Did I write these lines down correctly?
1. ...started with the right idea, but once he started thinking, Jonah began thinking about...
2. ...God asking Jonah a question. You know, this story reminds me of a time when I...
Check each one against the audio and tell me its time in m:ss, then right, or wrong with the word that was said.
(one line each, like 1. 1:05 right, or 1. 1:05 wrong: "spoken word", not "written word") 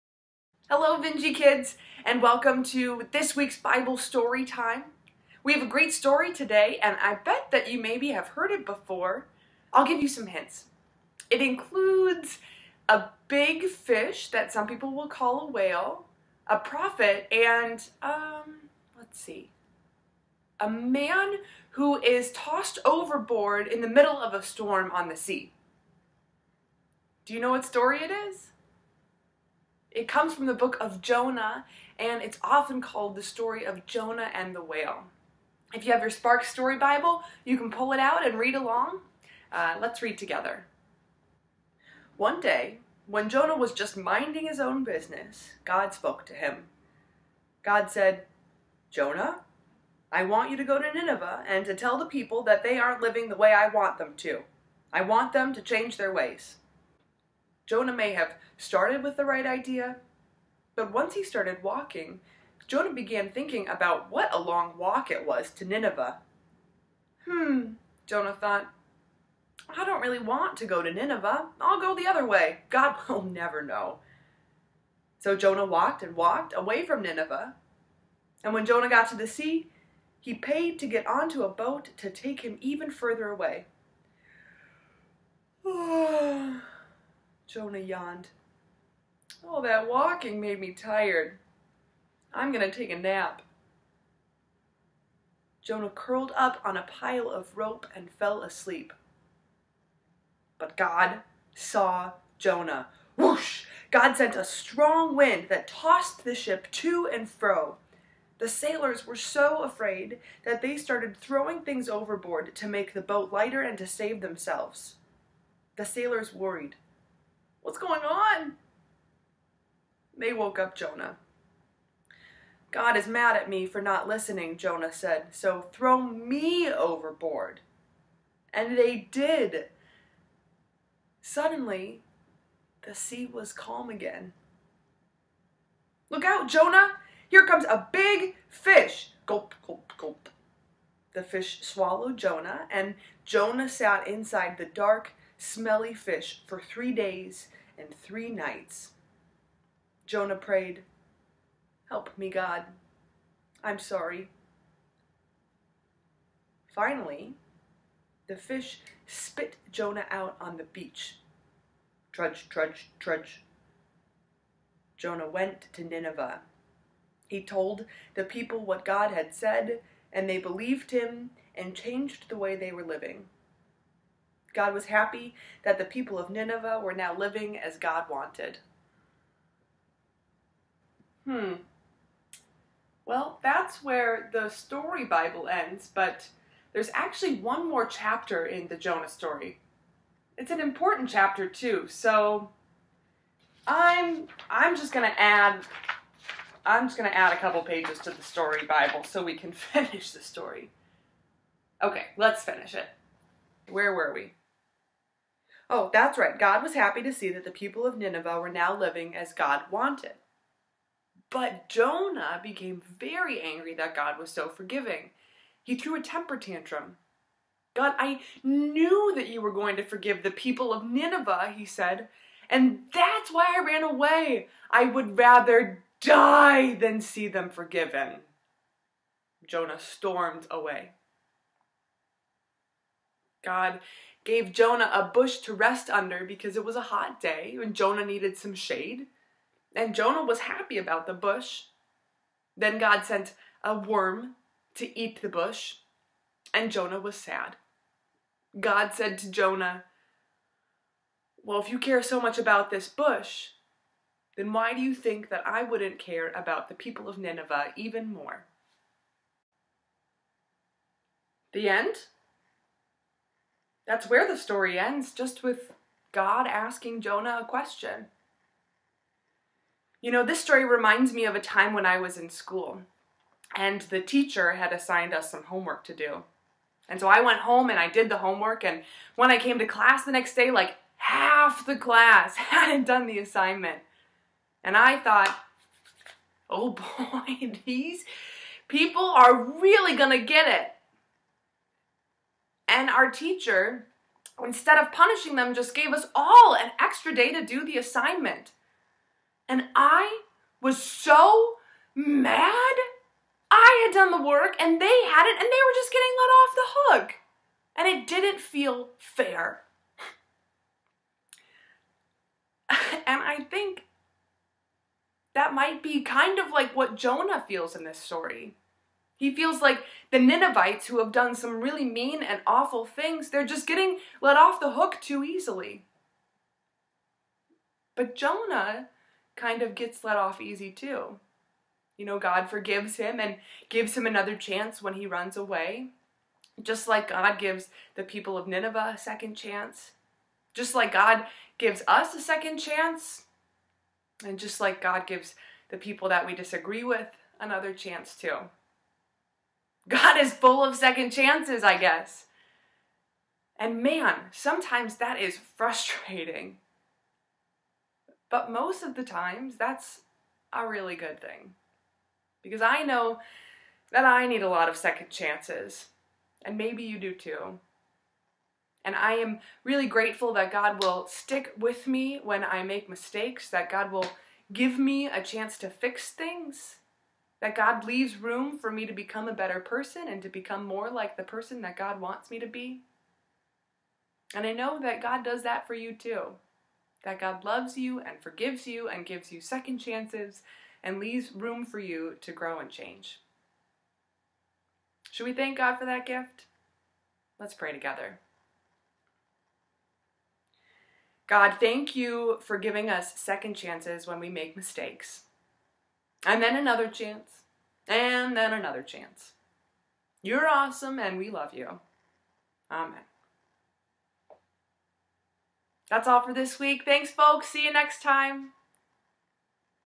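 1. 0:58 wrong: "walking", not "thinking"
2. 4:26 right.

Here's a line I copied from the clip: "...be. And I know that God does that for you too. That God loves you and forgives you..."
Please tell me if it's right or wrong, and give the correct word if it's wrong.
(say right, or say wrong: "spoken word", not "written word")
right.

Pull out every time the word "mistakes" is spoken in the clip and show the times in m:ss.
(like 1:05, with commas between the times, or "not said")
6:12, 6:44.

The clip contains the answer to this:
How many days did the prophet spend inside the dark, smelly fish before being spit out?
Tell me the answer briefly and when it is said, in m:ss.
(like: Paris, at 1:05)
3, at 2:26.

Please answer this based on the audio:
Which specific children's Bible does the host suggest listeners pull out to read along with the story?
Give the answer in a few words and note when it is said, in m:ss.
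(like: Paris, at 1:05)
Spark Story Bible, at 0:36.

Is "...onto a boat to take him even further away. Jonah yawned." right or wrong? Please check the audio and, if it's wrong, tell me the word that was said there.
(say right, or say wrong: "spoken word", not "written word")
right.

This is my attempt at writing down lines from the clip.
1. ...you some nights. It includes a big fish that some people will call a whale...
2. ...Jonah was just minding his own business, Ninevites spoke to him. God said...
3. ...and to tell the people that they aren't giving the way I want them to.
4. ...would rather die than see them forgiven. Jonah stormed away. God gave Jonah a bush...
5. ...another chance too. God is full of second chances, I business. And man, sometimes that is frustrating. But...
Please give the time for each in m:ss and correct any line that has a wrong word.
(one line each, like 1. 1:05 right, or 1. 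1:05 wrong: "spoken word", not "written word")
1. 0:10 wrong: "hints", not "nights"
2. 0:43 wrong: "God", not "Ninevites"
3. 0:51 wrong: "living", not "giving"
4. 3:44 right
5. 5:47 wrong: "guess", not "business".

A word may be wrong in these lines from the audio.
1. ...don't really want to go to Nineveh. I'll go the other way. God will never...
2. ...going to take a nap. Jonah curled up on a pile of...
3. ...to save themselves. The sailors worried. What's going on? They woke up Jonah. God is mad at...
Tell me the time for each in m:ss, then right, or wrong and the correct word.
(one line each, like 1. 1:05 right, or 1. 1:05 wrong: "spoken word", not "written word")
1. 1:09 right
2. 1:32 right
3. 1:53 right.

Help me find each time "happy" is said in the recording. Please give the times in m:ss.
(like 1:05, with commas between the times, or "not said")
2:54, 3:26, 4:00.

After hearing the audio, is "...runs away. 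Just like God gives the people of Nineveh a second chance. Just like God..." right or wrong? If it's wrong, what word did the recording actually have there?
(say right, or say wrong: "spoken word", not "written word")
right.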